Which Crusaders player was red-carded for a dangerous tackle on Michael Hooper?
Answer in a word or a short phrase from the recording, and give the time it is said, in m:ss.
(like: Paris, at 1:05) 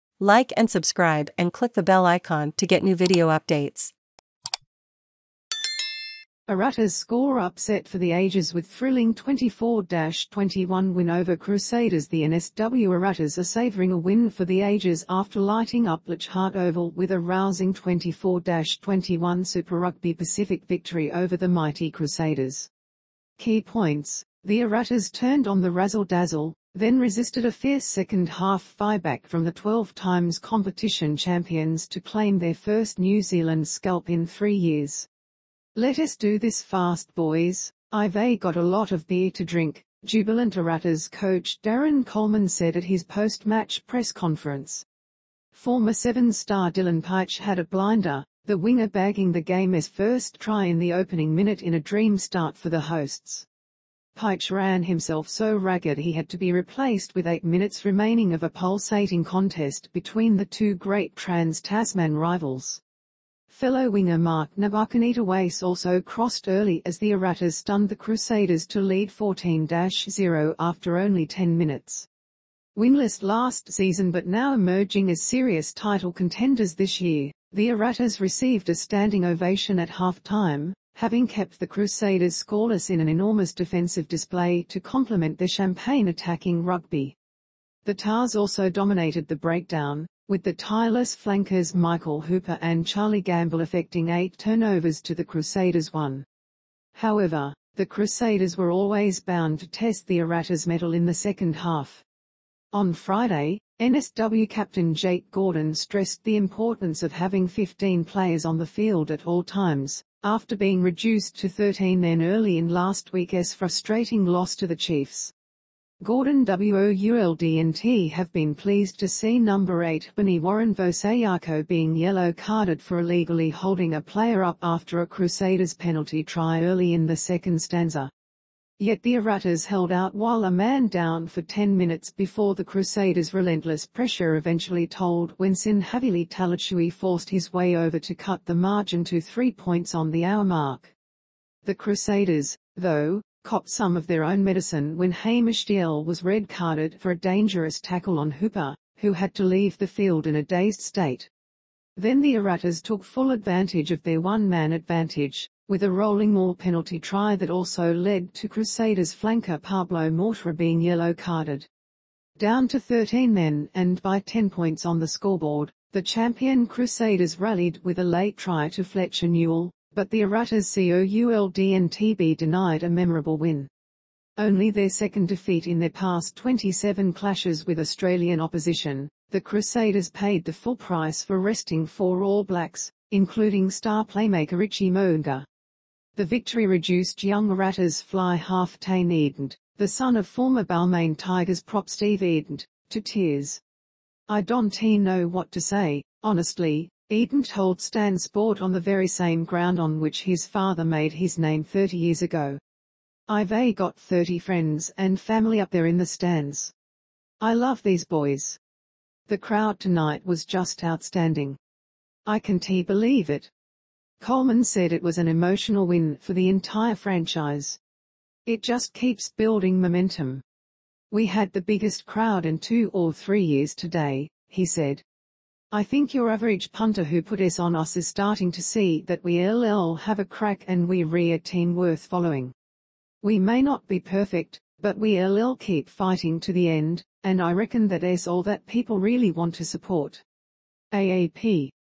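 Hamish Dalzell, at 2:25.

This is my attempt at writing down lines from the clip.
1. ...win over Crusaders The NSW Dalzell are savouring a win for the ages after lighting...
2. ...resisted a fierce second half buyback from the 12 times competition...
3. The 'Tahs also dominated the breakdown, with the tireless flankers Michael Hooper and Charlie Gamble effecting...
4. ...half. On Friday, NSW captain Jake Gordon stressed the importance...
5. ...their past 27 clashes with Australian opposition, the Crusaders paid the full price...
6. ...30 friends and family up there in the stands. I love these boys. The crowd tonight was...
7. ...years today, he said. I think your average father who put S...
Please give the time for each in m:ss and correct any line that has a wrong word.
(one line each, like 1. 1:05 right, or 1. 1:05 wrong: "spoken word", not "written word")
1. 0:10 wrong: "Waratahs", not "Dalzell"
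2. 0:26 right
3. 1:27 right
4. 1:41 right
5. 2:55 right
6. 3:23 right
7. 3:43 wrong: "punter", not "father".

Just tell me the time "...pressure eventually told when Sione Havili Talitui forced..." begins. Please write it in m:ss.
2:13.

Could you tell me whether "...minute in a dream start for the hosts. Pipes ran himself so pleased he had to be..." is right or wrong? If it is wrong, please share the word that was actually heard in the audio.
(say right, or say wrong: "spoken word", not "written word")
wrong: "ragged", not "pleased".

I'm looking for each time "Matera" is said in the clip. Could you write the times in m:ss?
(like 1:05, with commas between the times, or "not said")
2:40.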